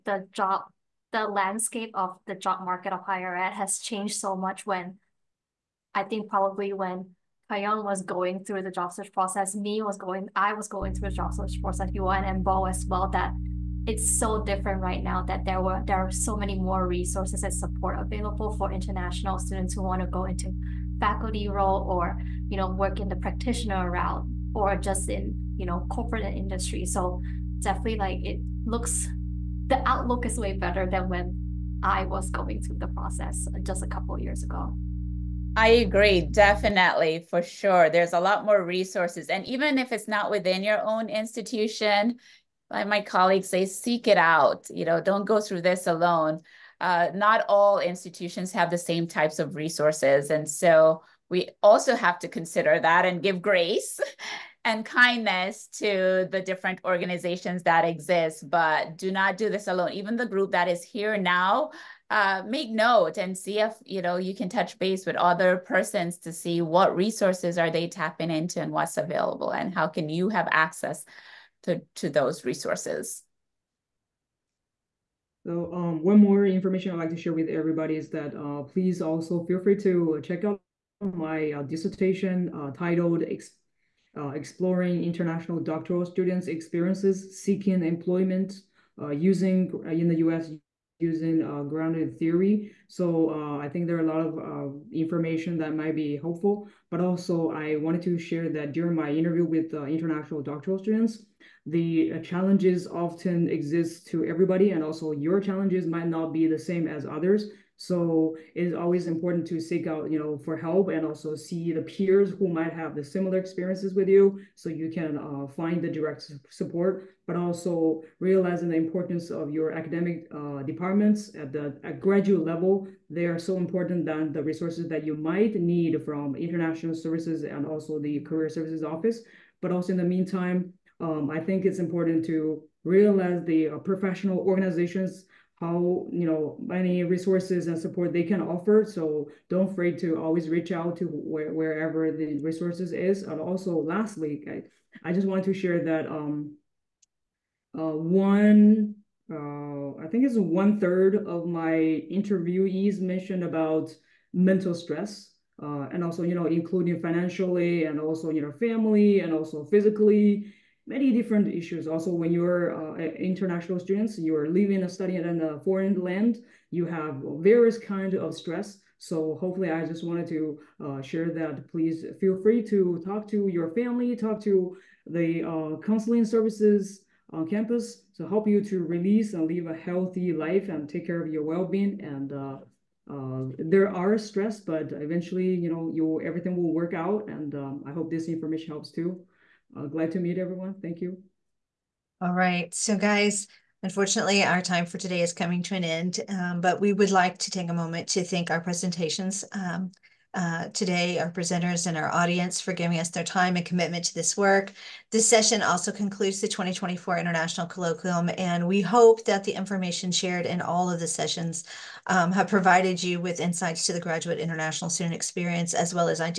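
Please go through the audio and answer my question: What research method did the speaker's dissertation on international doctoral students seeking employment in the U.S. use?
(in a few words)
Grounded theory.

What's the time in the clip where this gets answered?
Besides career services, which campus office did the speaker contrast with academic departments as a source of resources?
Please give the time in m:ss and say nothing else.
2:06.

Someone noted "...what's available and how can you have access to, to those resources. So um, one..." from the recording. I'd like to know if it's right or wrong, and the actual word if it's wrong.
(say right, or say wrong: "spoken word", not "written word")
right.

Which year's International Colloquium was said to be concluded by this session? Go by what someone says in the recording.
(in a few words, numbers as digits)
2024.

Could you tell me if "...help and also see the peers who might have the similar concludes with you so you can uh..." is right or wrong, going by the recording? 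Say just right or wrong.
wrong.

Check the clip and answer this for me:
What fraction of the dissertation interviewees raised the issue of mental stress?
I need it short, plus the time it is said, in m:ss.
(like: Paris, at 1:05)
One third, at 2:30.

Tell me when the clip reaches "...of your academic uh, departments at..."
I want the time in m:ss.
1:59.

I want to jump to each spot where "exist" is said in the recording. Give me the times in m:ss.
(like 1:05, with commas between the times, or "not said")
0:57, 1:43.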